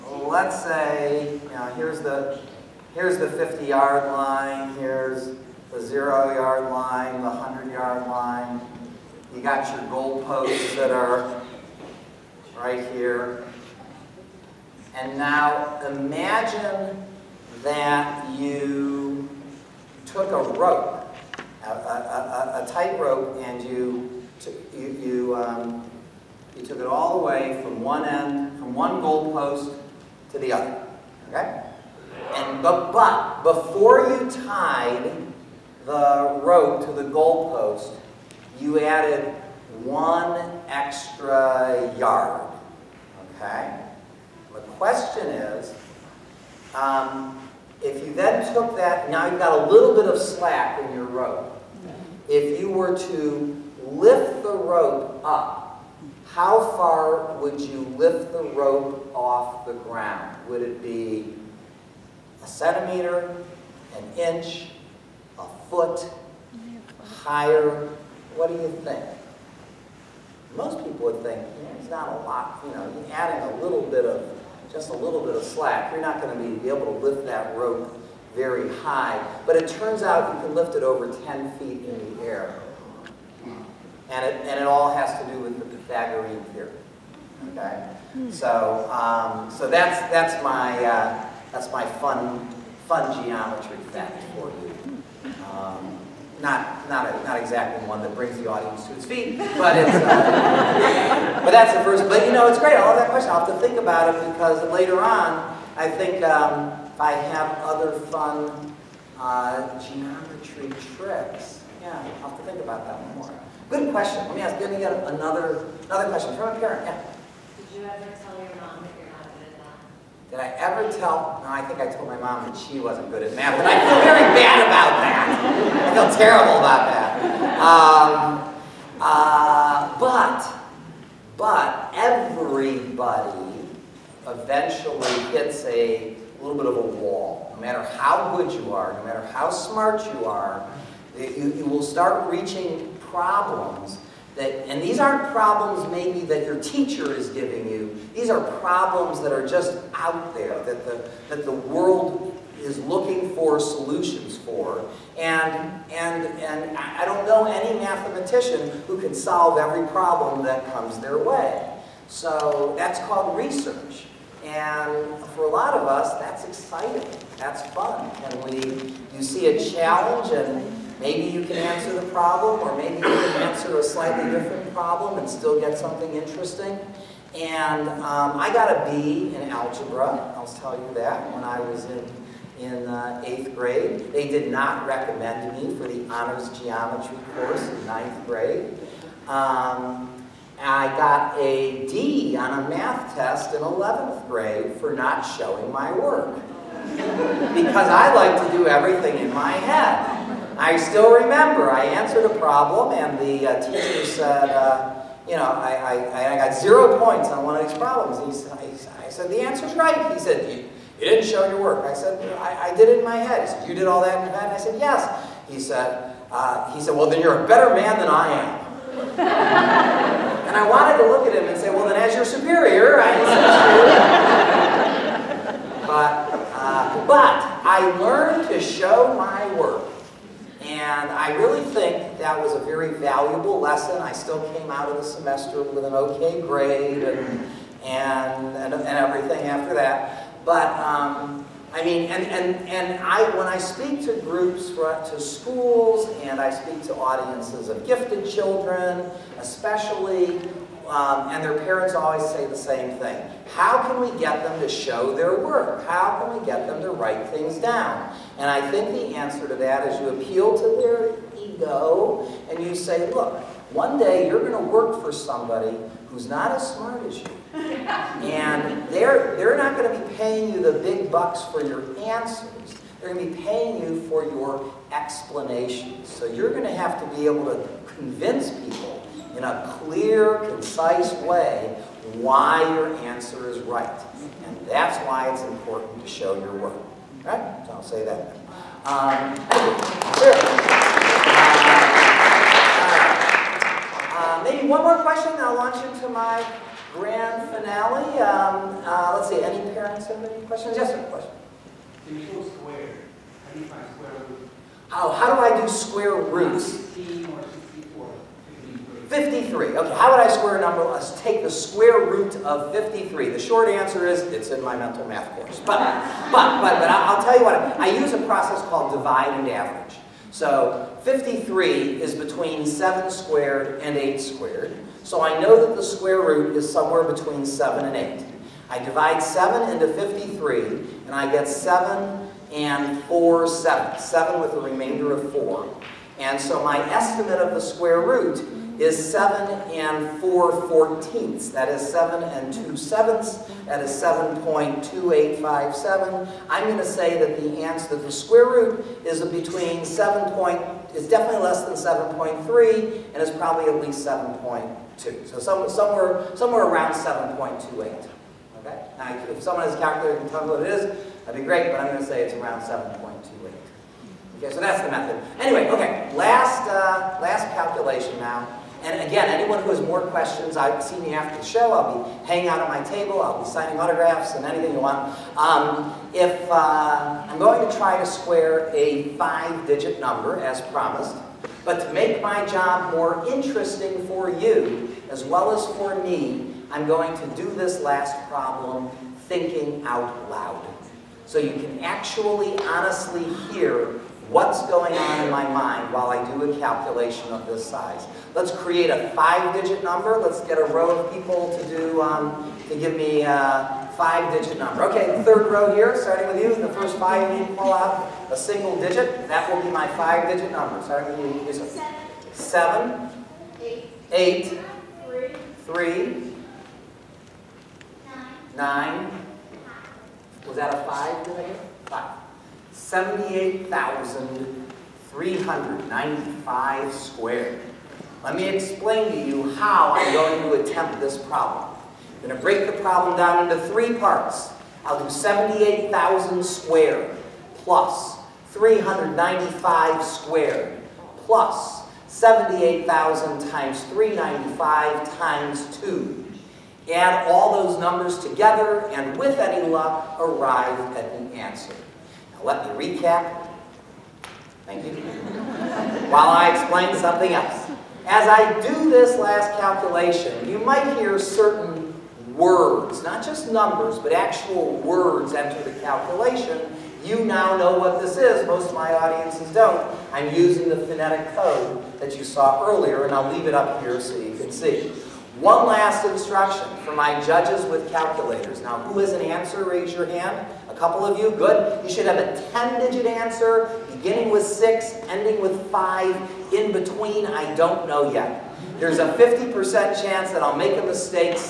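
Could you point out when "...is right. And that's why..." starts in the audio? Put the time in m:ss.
4:43.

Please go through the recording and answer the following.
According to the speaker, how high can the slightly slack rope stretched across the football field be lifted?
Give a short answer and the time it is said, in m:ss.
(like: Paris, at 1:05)
Over 10 feet, at 1:20.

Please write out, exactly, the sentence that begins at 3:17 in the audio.
because I like to do everything in my head.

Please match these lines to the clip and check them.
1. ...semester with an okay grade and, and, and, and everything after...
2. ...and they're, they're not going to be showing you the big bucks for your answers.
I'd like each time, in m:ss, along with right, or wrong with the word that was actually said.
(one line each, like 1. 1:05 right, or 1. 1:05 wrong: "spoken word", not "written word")
1. 3:55 right
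2. 4:27 wrong: "paying", not "showing".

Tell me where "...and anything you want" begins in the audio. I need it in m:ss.
6:14.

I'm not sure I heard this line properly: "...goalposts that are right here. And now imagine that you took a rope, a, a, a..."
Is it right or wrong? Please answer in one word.
right.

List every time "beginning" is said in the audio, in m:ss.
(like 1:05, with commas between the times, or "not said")
8:03.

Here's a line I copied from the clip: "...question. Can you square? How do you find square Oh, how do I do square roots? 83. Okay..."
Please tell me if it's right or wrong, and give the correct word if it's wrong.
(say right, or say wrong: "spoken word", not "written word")
wrong: "53", not "83".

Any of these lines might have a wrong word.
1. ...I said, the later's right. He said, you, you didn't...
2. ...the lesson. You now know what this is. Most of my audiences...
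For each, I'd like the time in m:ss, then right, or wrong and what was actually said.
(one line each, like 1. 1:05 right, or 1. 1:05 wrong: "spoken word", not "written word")
1. 3:29 wrong: "answer", not "later"
2. 7:45 wrong: "calculation", not "lesson".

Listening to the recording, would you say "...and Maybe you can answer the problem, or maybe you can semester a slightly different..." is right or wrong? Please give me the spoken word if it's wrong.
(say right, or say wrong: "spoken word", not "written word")
wrong: "answer", not "semester".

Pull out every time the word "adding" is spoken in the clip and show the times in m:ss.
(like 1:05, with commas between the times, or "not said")
1:13.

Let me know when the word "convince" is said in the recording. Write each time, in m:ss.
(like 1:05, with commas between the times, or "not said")
4:37.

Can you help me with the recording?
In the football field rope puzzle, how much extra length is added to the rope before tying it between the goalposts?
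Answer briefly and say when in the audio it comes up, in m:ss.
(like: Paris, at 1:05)
1 yard, at 0:39.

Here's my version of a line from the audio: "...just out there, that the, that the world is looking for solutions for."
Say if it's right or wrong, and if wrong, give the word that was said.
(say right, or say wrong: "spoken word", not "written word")
right.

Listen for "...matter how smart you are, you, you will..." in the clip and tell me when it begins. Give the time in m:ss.
2:19.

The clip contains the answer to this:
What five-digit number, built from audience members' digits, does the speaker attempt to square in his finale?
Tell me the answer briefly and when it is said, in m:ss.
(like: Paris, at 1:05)
78,395, at 7:02.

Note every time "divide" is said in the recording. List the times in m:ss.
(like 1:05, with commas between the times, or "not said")
5:18, 5:28.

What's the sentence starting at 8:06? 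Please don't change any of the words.
In between, I don't know yet.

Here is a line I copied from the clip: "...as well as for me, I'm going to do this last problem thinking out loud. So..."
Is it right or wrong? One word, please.
right.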